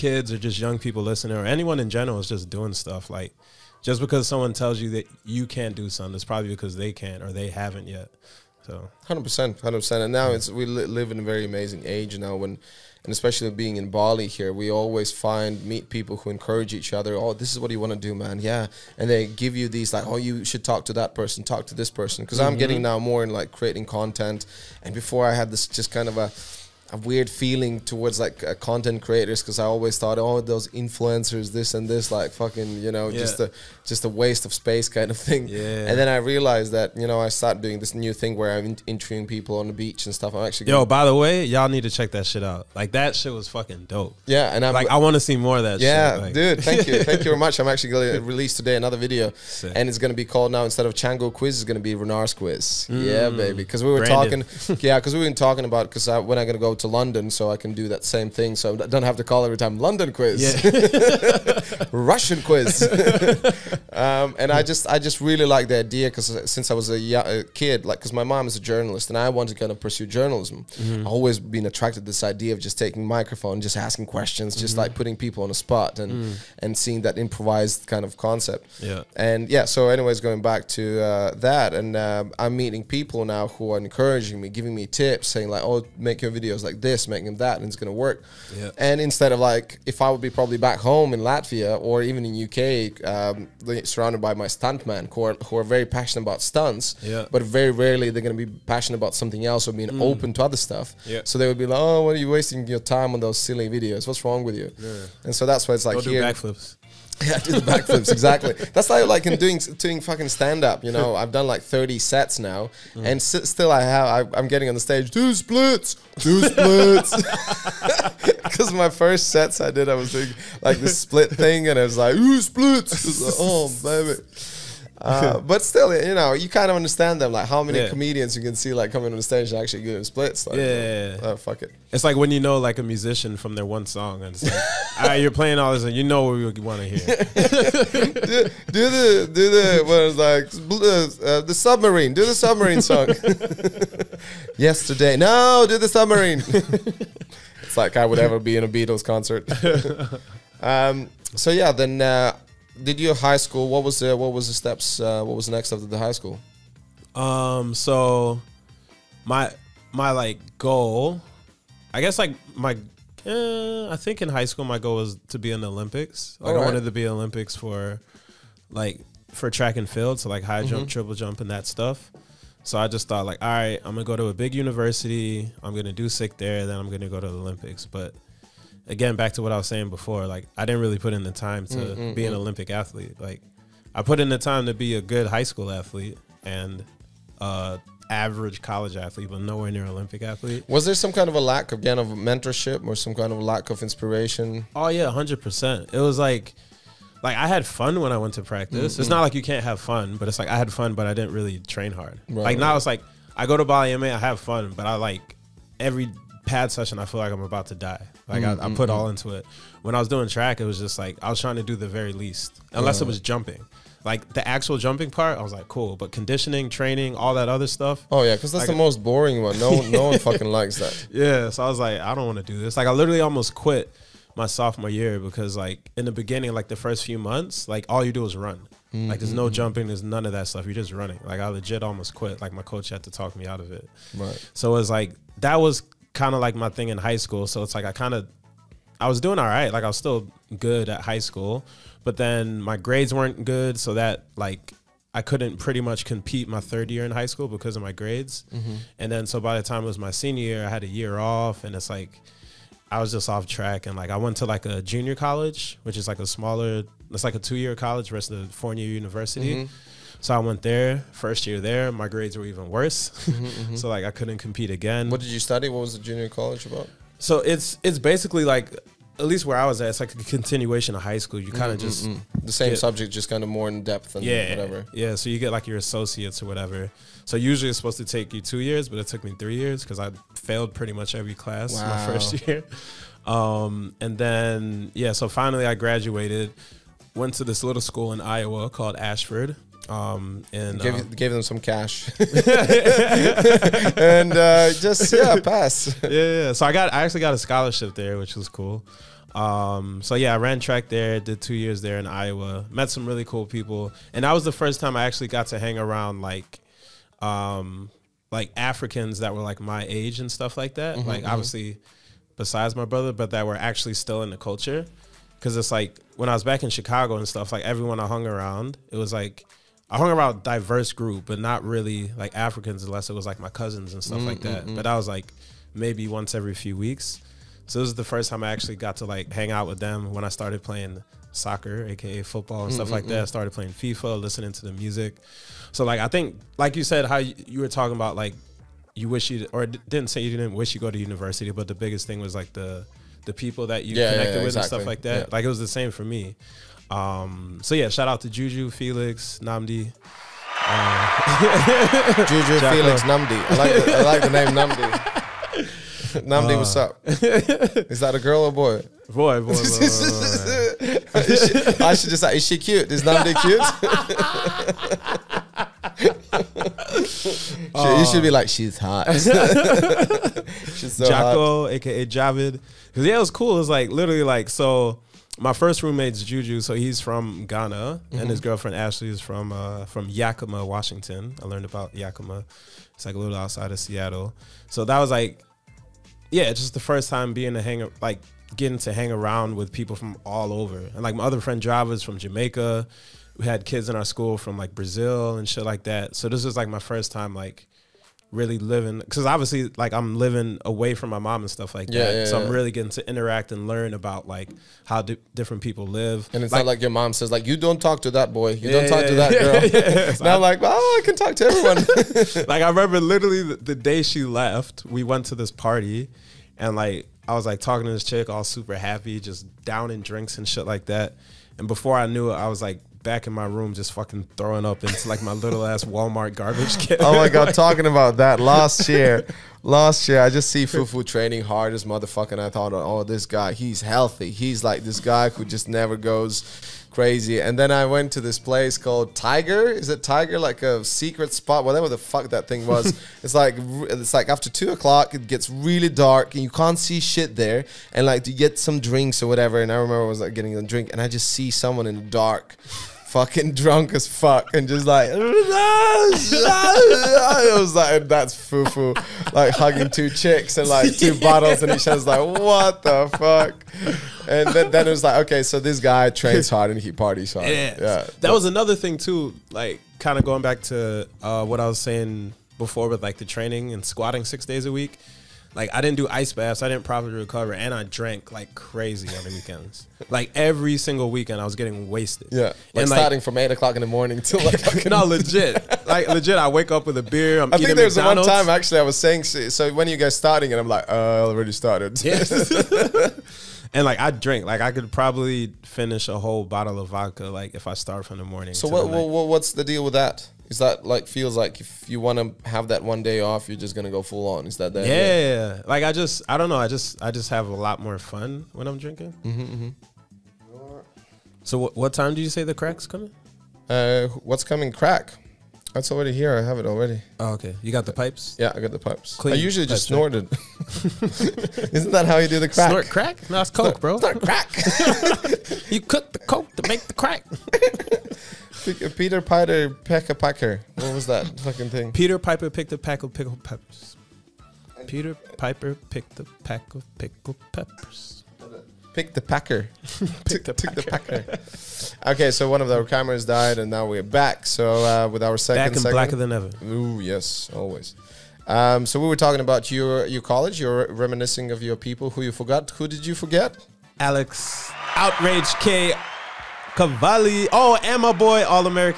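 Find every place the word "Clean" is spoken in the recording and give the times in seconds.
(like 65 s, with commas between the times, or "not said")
519 s.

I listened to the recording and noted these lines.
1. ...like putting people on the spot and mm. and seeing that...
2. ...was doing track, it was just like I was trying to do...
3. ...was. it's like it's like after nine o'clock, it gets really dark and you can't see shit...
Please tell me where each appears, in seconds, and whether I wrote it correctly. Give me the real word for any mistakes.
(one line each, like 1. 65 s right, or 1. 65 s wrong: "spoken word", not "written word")
1. 74 s right
2. 209 s right
3. 442 s wrong: "two", not "nine".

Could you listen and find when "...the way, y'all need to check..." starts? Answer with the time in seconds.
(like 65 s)
41 s.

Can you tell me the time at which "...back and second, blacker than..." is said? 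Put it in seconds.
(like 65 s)
545 s.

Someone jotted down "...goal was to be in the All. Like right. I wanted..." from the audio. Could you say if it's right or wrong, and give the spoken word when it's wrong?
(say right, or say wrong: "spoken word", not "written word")
wrong: "Olympics", not "All".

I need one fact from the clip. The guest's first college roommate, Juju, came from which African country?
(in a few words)
Ghana.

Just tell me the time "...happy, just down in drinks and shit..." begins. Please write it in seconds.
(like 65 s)
418 s.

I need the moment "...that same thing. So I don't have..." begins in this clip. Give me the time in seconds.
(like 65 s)
57 s.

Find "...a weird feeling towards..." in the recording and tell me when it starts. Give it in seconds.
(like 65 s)
26 s.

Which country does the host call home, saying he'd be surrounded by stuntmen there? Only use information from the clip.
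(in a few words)
Latvia.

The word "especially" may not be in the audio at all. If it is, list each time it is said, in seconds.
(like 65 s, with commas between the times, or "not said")
13 s.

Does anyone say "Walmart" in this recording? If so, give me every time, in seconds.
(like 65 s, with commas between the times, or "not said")
425 s.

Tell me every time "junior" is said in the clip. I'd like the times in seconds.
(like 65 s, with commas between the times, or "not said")
254 s, 266 s.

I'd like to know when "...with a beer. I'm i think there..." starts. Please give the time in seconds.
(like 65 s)
486 s.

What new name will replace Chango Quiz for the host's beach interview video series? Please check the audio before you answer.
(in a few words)
Renar's Quiz.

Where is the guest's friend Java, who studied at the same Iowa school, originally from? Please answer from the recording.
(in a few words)
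Jamaica.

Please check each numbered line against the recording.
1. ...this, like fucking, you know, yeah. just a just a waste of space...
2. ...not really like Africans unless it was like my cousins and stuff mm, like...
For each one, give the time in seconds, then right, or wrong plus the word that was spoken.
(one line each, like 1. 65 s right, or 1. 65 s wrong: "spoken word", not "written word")
1. 31 s right
2. 321 s right.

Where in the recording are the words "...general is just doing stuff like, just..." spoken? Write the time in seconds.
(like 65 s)
1 s.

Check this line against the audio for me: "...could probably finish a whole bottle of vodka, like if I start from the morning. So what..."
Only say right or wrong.
right.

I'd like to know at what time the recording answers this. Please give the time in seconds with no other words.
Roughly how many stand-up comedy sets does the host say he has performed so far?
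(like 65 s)
111 s.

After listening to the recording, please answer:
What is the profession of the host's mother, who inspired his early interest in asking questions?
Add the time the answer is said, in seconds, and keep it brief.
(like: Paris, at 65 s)
Journalist, at 68 s.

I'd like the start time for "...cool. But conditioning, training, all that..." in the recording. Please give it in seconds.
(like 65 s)
215 s.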